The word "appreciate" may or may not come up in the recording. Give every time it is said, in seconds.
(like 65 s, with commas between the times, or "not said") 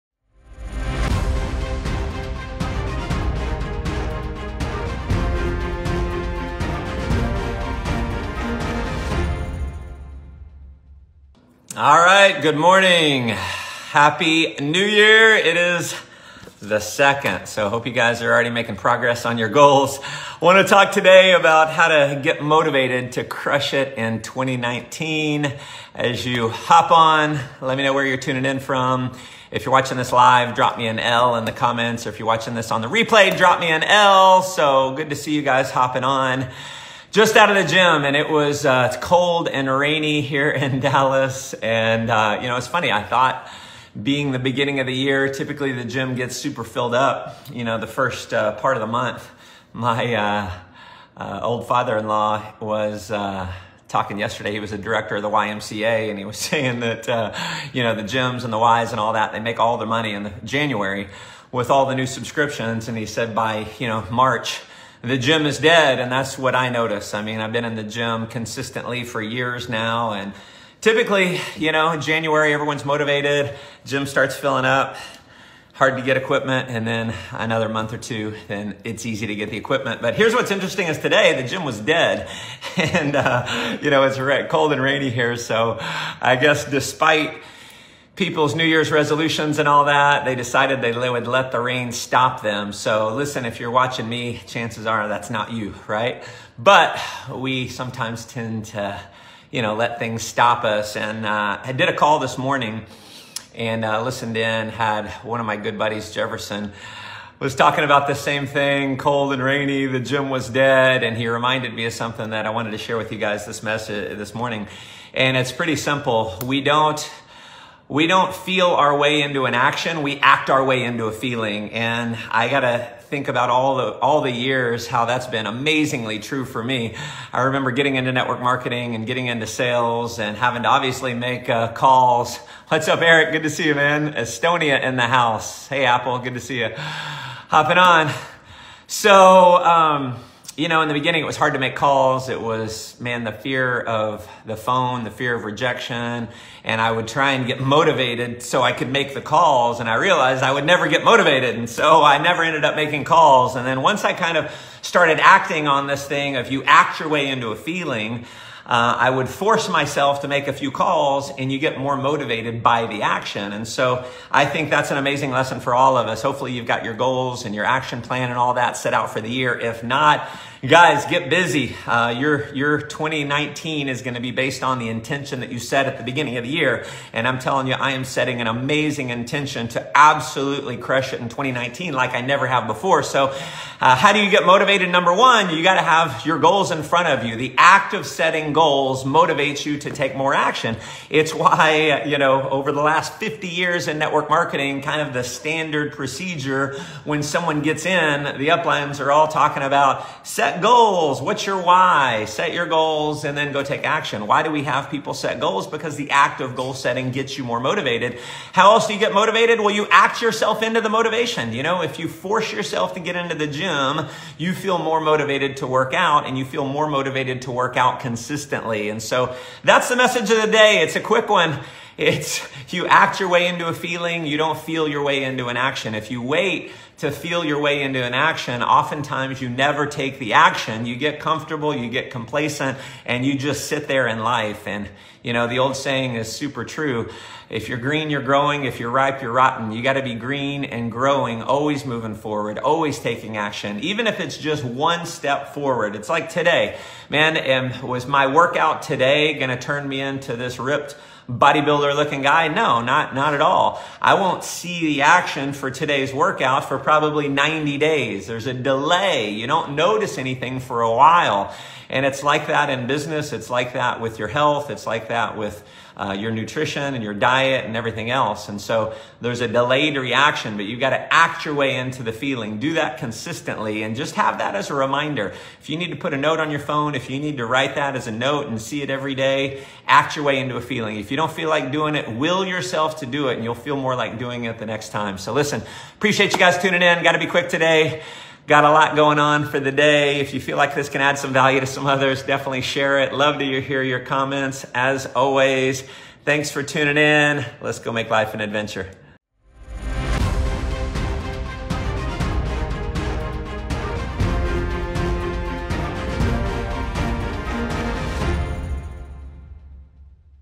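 285 s.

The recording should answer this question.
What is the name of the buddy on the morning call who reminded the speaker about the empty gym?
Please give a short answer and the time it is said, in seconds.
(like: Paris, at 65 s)
Jefferson, at 106 s.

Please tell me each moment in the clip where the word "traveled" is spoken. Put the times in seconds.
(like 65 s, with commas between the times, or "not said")
not said.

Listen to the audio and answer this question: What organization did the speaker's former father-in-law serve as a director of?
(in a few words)
YMCA.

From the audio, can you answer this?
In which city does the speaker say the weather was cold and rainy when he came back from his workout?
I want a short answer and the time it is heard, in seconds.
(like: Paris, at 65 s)
Dallas, at 40 s.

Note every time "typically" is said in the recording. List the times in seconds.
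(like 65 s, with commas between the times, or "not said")
45 s, 70 s.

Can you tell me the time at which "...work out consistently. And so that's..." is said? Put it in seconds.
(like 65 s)
217 s.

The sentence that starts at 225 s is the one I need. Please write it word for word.
If you wait to feel your way into an action, oftentimes you never take the action.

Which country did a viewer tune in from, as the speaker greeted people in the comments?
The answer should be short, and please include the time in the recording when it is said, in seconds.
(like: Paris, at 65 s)
Estonia, at 134 s.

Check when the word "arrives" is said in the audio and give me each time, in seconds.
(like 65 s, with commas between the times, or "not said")
not said.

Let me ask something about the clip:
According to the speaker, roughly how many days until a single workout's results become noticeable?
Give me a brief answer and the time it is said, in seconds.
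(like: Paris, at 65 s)
90, at 257 s.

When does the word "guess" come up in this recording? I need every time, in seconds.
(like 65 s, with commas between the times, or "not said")
86 s.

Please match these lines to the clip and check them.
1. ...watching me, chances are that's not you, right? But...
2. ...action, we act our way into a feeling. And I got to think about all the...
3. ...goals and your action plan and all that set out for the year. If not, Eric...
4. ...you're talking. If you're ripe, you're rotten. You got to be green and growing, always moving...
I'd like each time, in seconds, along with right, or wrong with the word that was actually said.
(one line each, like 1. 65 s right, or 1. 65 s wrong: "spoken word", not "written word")
1. 93 s right
2. 119 s right
3. 166 s wrong: "Guys", not "Eric"
4. 238 s wrong: "growing", not "talking".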